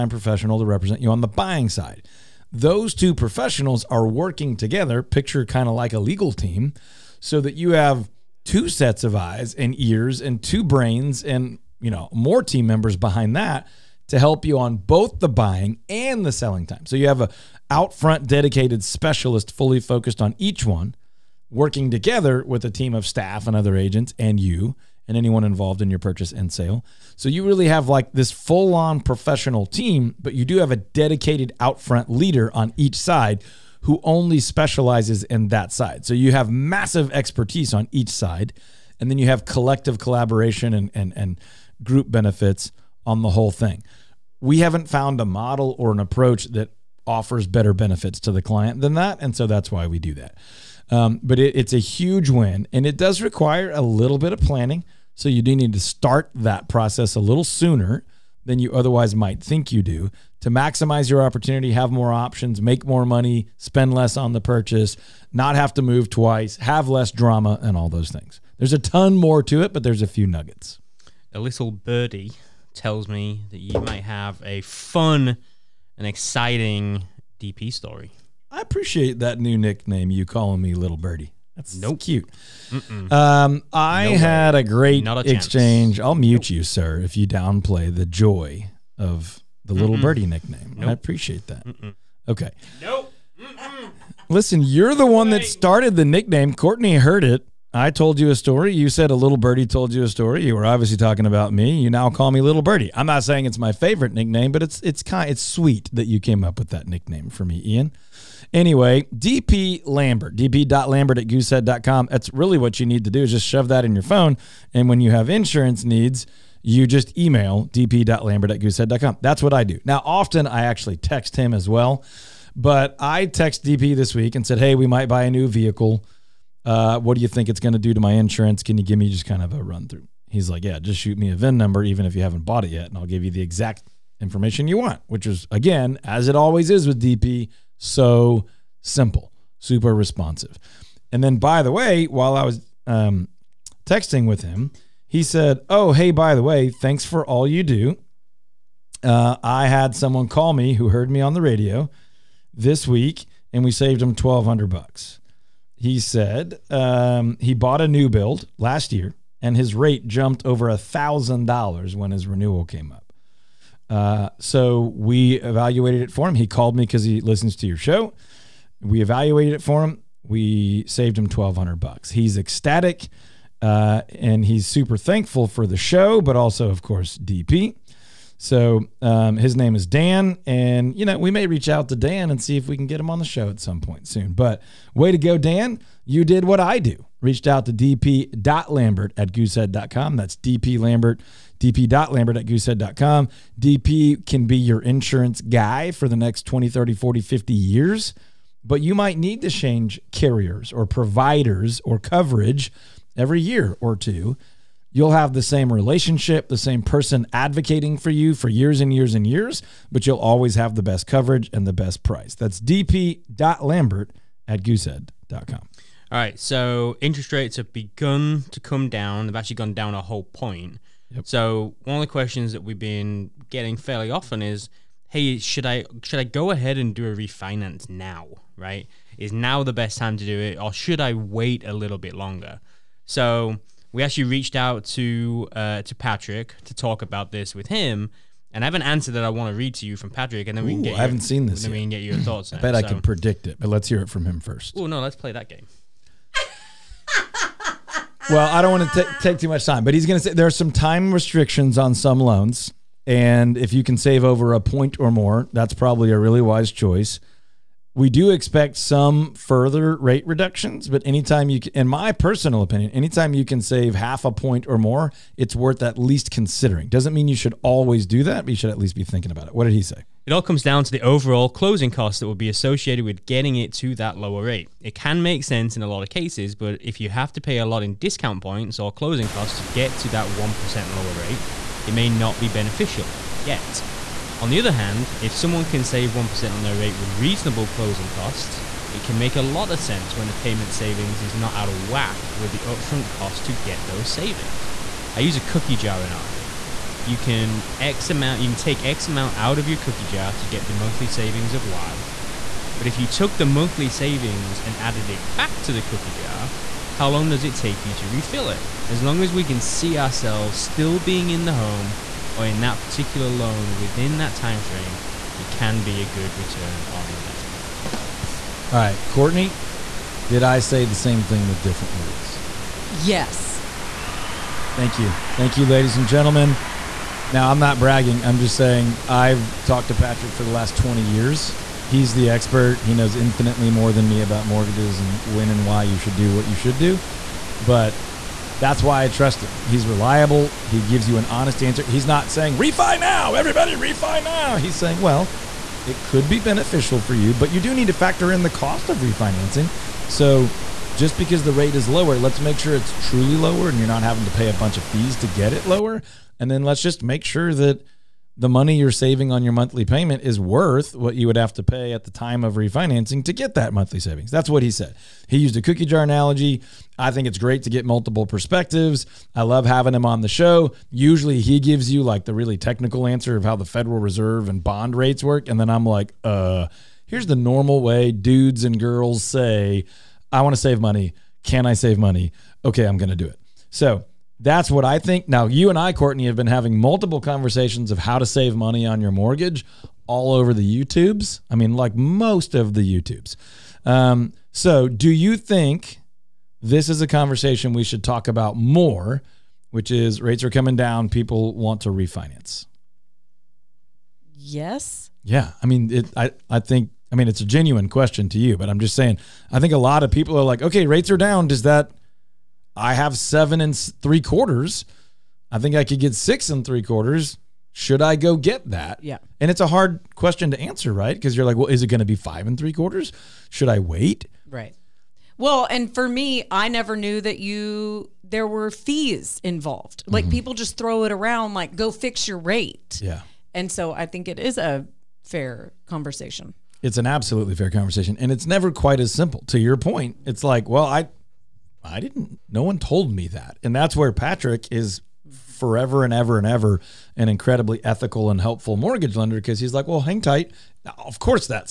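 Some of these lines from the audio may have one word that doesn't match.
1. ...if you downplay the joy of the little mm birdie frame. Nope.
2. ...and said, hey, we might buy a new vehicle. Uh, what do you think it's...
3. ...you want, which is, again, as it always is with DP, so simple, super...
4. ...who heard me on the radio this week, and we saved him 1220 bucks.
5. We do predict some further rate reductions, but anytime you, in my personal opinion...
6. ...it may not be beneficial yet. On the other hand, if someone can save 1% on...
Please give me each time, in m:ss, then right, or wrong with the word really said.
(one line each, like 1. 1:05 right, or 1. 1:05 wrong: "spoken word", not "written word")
1. 1:26 wrong: "nickname", not "frame"
2. 2:04 right
3. 2:14 right
4. 2:30 wrong: "1200", not "1220"
5. 4:18 wrong: "expect", not "predict"
6. 4:41 right.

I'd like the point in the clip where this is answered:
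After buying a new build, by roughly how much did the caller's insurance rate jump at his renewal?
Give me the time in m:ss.
2:40.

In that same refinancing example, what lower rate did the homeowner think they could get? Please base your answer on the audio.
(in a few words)
six and three quarters.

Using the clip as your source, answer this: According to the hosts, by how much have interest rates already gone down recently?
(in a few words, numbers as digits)
a whole point.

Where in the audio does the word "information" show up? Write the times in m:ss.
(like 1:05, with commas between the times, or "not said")
2:14.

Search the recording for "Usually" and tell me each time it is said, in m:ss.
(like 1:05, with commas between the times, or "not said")
6:10.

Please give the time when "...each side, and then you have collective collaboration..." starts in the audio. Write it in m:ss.
0:37.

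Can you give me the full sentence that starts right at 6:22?
Okay, I'm going to do it.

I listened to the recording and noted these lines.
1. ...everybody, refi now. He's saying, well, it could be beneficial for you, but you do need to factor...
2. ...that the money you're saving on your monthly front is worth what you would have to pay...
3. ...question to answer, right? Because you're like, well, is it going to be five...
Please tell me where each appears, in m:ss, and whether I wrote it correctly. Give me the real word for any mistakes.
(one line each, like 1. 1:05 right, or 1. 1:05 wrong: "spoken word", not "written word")
1. 5:43 right
2. 5:57 wrong: "payment", not "front"
3. 7:00 right.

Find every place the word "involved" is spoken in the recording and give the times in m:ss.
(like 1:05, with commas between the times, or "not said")
0:25, 7:09.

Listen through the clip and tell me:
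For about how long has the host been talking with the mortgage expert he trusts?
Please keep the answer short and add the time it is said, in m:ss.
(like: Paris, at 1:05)
20 years, at 5:30.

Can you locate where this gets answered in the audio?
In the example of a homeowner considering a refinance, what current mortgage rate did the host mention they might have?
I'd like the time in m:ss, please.
6:53.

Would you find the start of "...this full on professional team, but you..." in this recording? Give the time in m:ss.
0:28.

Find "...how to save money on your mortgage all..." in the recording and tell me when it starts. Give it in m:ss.
6:27.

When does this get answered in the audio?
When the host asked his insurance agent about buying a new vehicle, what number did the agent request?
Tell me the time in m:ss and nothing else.
2:11.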